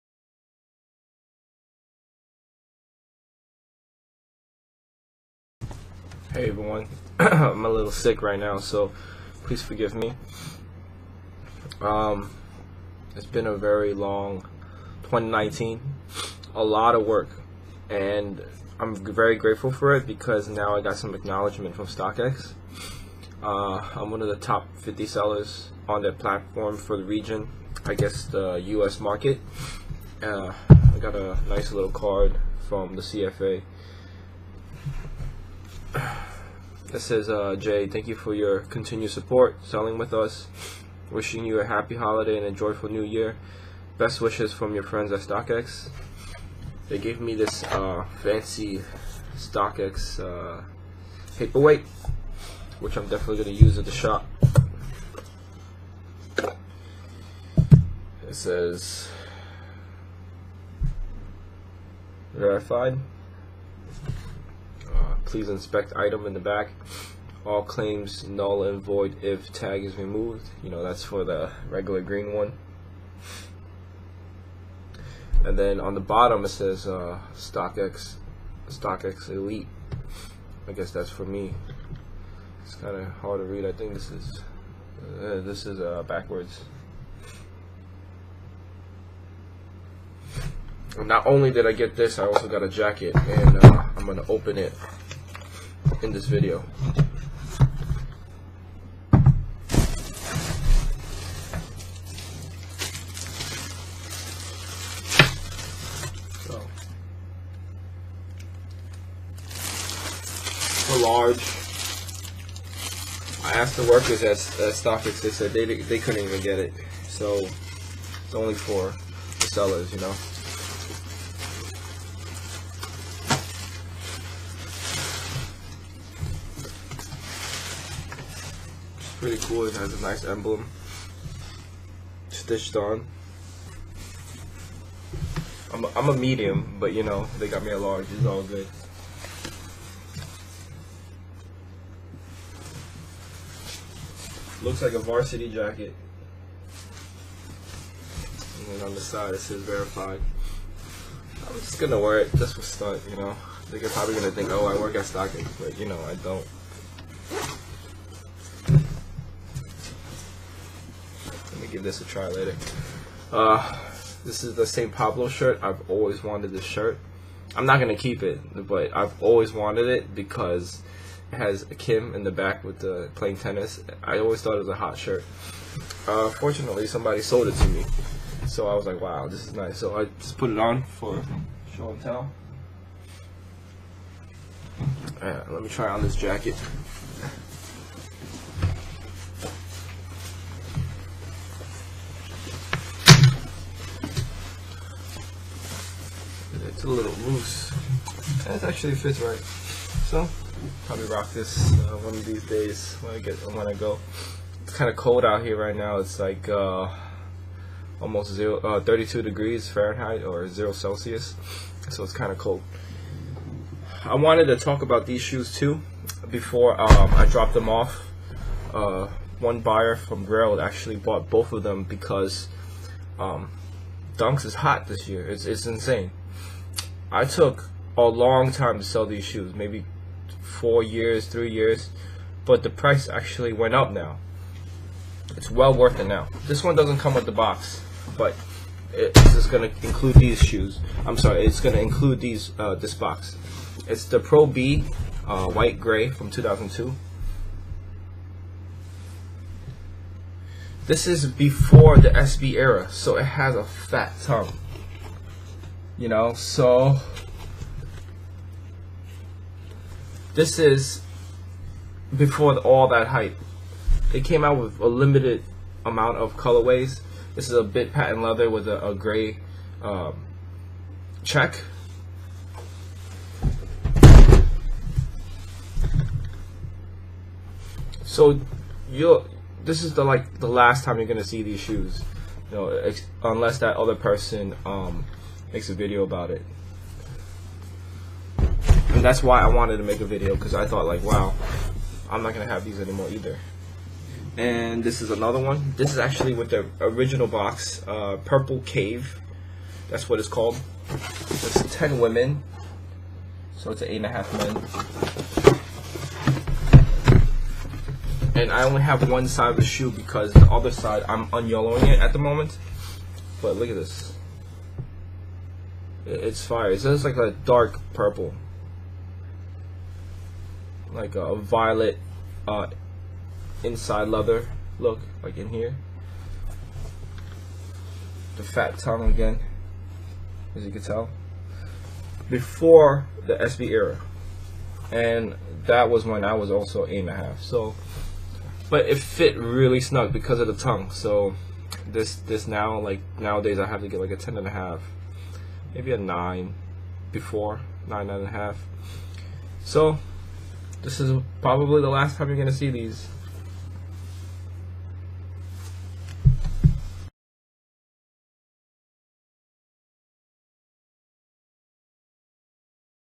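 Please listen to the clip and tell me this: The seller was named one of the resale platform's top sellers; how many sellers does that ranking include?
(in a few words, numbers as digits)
50.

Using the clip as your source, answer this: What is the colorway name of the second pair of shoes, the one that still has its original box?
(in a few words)
Purple Cave.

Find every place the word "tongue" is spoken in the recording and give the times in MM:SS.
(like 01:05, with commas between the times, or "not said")
04:14, 05:28, 05:40.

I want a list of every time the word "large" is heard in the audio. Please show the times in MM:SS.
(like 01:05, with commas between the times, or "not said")
01:50, 02:17.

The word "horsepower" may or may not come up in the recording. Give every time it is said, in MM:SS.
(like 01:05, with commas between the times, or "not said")
not said.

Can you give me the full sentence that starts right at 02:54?
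I always thought it was a hot shirt.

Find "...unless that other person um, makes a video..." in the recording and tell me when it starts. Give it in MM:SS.
04:43.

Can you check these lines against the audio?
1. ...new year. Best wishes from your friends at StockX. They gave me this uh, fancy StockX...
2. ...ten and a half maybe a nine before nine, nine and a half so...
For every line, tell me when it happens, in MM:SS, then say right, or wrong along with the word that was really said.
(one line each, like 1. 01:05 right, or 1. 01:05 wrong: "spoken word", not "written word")
1. 00:42 right
2. 05:44 right.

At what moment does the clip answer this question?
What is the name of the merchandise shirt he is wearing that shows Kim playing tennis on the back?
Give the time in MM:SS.
02:44.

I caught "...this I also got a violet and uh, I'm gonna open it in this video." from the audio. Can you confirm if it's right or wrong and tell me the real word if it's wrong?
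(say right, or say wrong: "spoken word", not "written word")
wrong: "jacket", not "violet".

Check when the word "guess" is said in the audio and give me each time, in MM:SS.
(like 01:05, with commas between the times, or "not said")
00:27, 01:20.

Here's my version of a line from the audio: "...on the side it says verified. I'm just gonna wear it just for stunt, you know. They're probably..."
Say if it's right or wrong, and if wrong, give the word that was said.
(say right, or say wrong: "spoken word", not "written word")
right.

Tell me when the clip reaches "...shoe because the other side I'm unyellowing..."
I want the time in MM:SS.
05:09.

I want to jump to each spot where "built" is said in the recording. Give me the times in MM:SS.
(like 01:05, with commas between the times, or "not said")
not said.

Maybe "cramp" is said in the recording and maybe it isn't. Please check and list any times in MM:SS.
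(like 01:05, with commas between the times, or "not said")
not said.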